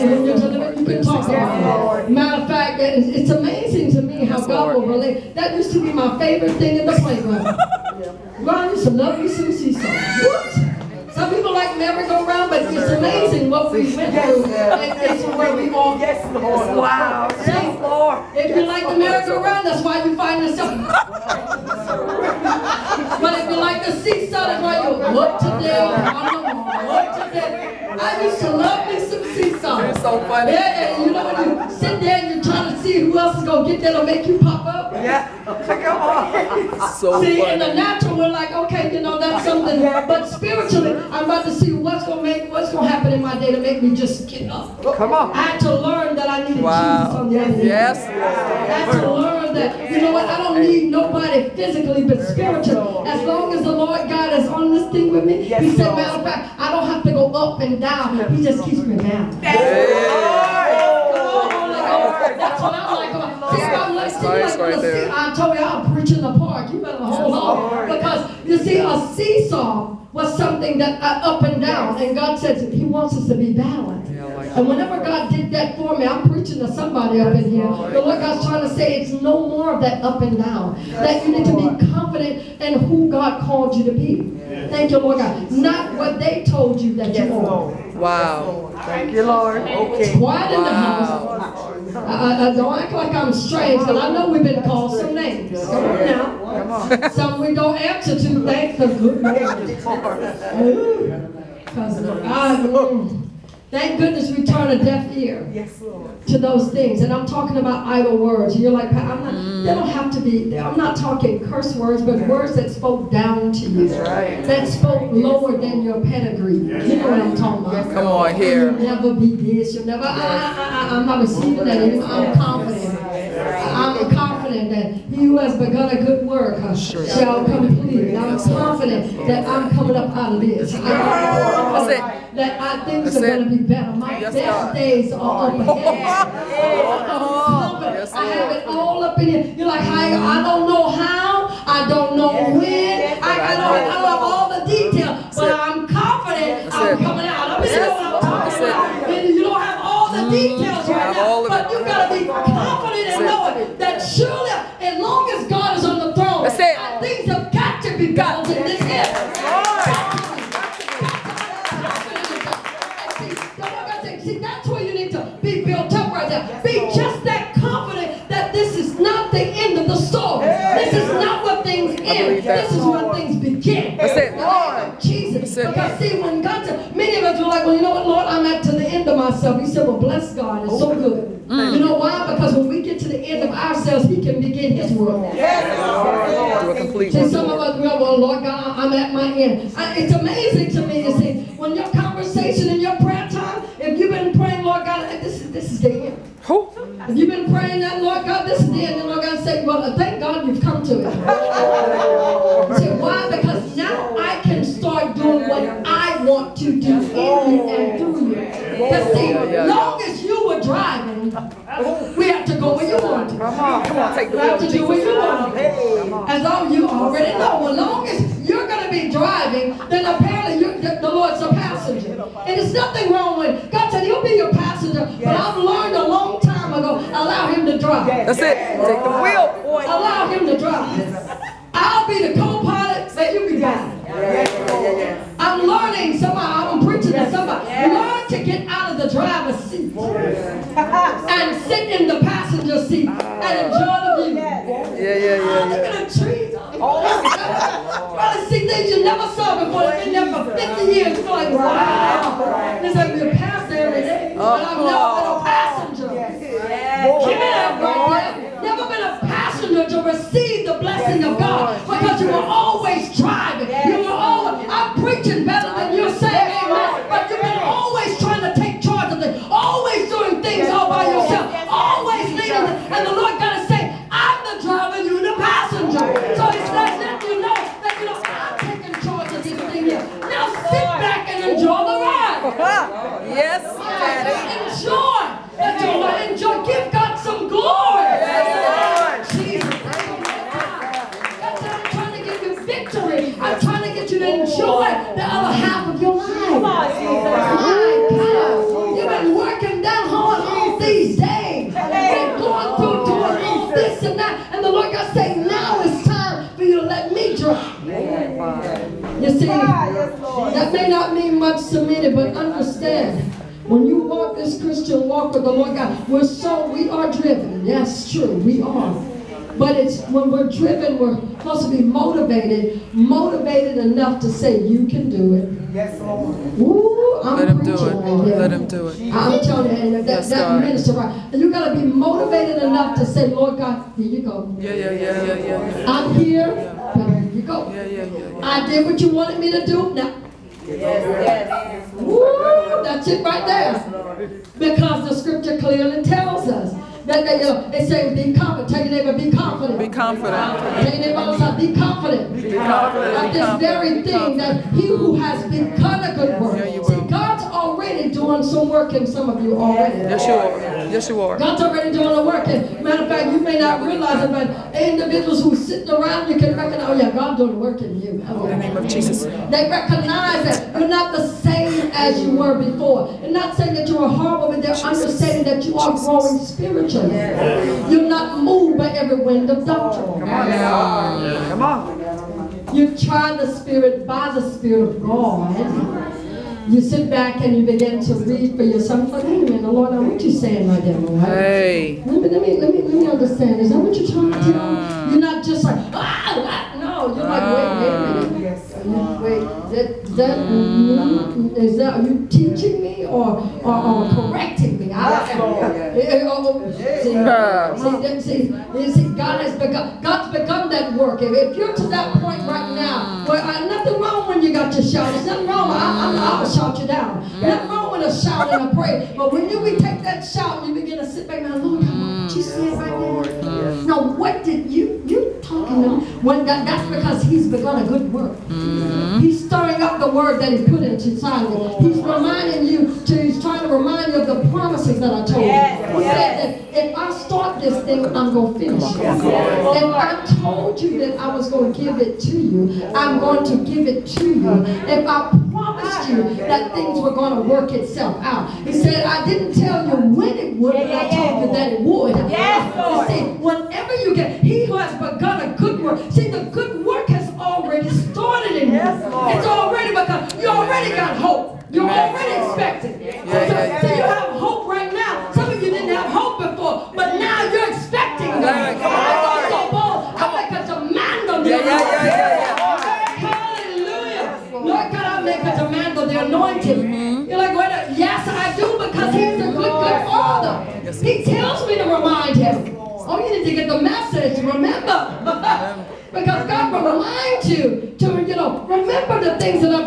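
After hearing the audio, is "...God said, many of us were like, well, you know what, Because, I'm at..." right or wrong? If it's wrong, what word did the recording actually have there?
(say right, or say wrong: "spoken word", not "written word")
wrong: "Lord", not "Because".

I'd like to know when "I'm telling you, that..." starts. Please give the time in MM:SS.
05:29.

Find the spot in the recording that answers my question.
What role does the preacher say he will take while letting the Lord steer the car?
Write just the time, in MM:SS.
03:51.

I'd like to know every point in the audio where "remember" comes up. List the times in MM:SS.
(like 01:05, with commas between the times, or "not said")
08:04, 08:08.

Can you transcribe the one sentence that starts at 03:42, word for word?
And there's nothing wrong with God said he'll be your passenger, but I've learned a long time ago, allow him to drive.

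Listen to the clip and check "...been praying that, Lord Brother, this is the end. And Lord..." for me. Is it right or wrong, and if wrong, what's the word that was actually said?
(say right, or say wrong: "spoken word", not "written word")
wrong: "God", not "Brother".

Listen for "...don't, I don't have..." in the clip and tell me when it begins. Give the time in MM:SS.
02:23.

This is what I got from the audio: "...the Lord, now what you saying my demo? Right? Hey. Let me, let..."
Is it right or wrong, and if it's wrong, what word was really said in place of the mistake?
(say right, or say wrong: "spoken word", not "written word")
right.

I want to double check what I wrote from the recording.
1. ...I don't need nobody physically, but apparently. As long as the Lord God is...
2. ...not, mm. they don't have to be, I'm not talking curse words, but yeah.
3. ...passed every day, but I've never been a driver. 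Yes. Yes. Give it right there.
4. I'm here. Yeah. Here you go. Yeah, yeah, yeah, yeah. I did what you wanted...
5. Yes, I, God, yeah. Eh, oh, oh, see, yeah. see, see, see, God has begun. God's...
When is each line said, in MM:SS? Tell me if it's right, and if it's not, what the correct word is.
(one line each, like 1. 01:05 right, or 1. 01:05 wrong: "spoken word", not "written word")
1. 00:50 wrong: "spiritually", not "apparently"
2. 01:49 right
3. 04:13 wrong: "passenger", not "driver"
4. 05:35 right
5. 06:44 wrong: "Lord", not "God".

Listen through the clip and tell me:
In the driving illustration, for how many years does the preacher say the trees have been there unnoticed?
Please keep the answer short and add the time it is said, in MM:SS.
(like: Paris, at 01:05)
50, at 04:09.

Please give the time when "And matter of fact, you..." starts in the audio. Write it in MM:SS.
06:02.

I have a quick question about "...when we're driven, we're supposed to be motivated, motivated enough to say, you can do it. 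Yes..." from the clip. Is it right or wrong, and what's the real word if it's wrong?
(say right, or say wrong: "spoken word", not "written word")
right.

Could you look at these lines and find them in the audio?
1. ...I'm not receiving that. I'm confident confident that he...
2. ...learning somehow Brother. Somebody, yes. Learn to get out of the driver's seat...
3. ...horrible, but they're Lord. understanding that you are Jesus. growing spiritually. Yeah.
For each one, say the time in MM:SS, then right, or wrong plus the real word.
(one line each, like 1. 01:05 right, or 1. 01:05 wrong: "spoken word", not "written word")
1. 02:00 right
2. 03:55 wrong: "Yes", not "Brother"
3. 06:14 wrong: "Jesus", not "Lord".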